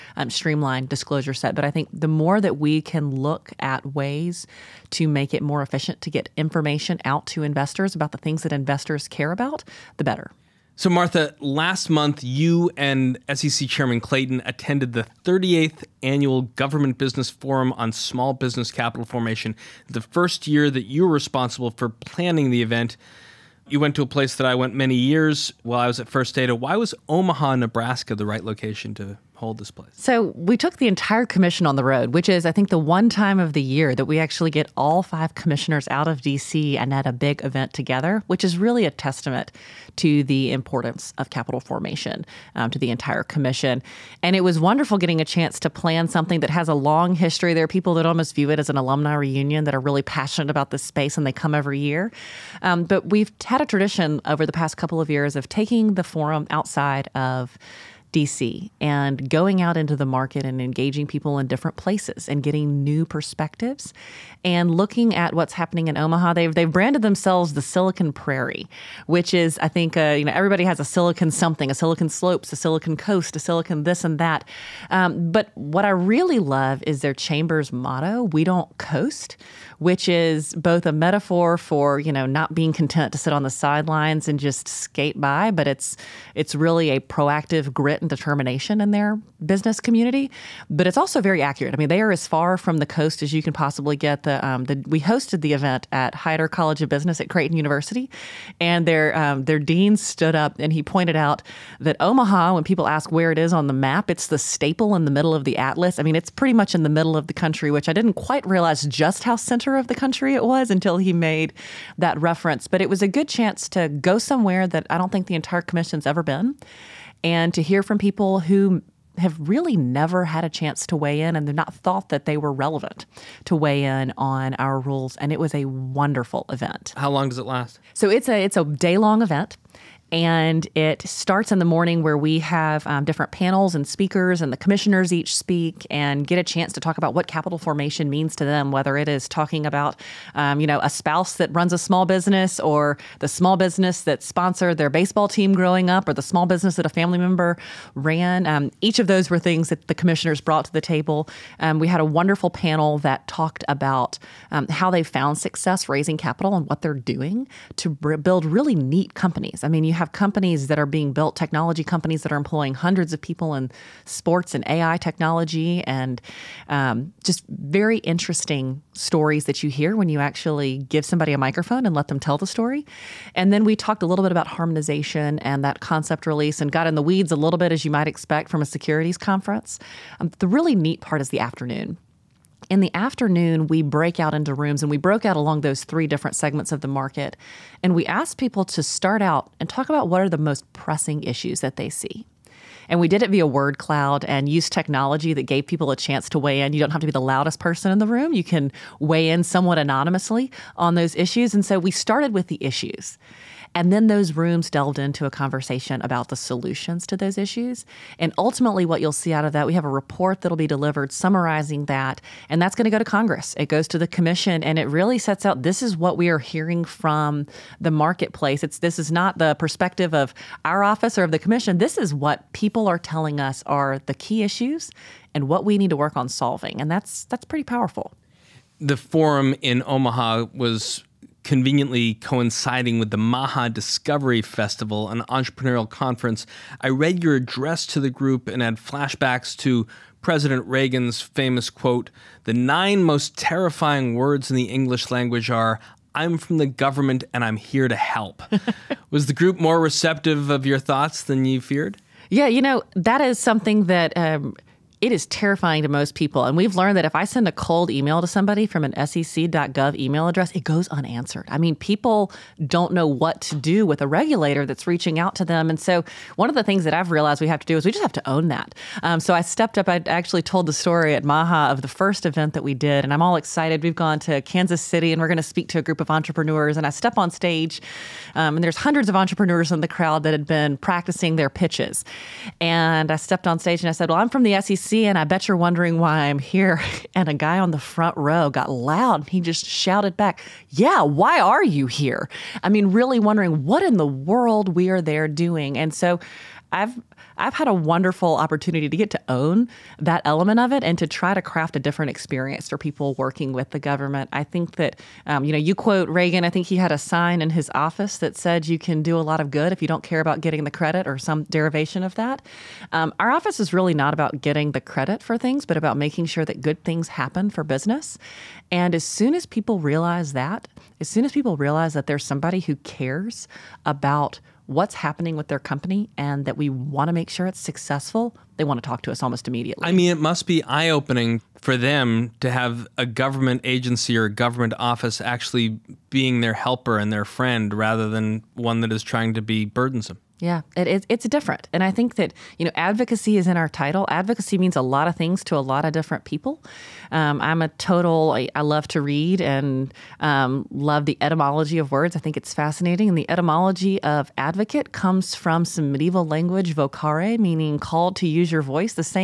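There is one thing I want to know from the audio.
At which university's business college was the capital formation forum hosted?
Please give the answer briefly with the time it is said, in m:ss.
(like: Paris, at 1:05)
Creighton University, at 1:37.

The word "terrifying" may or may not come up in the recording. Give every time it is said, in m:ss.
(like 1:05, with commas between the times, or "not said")
4:03, 4:15.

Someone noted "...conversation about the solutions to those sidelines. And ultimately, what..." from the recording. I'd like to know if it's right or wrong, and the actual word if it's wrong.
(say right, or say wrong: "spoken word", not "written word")
wrong: "issues", not "sidelines".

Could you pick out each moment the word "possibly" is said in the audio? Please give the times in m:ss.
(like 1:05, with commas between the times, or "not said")
1:33.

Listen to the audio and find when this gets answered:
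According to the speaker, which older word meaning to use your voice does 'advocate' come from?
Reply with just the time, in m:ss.
5:56.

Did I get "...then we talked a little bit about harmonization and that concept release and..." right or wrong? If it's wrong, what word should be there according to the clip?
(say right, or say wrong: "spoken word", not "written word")
right.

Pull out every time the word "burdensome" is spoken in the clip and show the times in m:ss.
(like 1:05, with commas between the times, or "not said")
5:39.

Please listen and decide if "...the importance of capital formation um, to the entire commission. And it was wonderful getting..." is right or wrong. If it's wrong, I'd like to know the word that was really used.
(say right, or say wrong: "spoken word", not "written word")
right.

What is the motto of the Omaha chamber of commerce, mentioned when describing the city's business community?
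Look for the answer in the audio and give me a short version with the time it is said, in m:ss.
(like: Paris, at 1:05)
We Don't Coast, at 1:18.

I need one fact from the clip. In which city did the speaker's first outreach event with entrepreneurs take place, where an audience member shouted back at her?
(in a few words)
Kansas City.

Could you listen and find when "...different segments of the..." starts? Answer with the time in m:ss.
3:06.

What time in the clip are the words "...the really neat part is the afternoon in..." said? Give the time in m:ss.
3:00.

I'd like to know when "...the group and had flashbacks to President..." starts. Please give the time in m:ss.
3:57.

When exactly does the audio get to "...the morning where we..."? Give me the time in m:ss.
2:11.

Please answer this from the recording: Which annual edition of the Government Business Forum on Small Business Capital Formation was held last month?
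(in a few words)
38th.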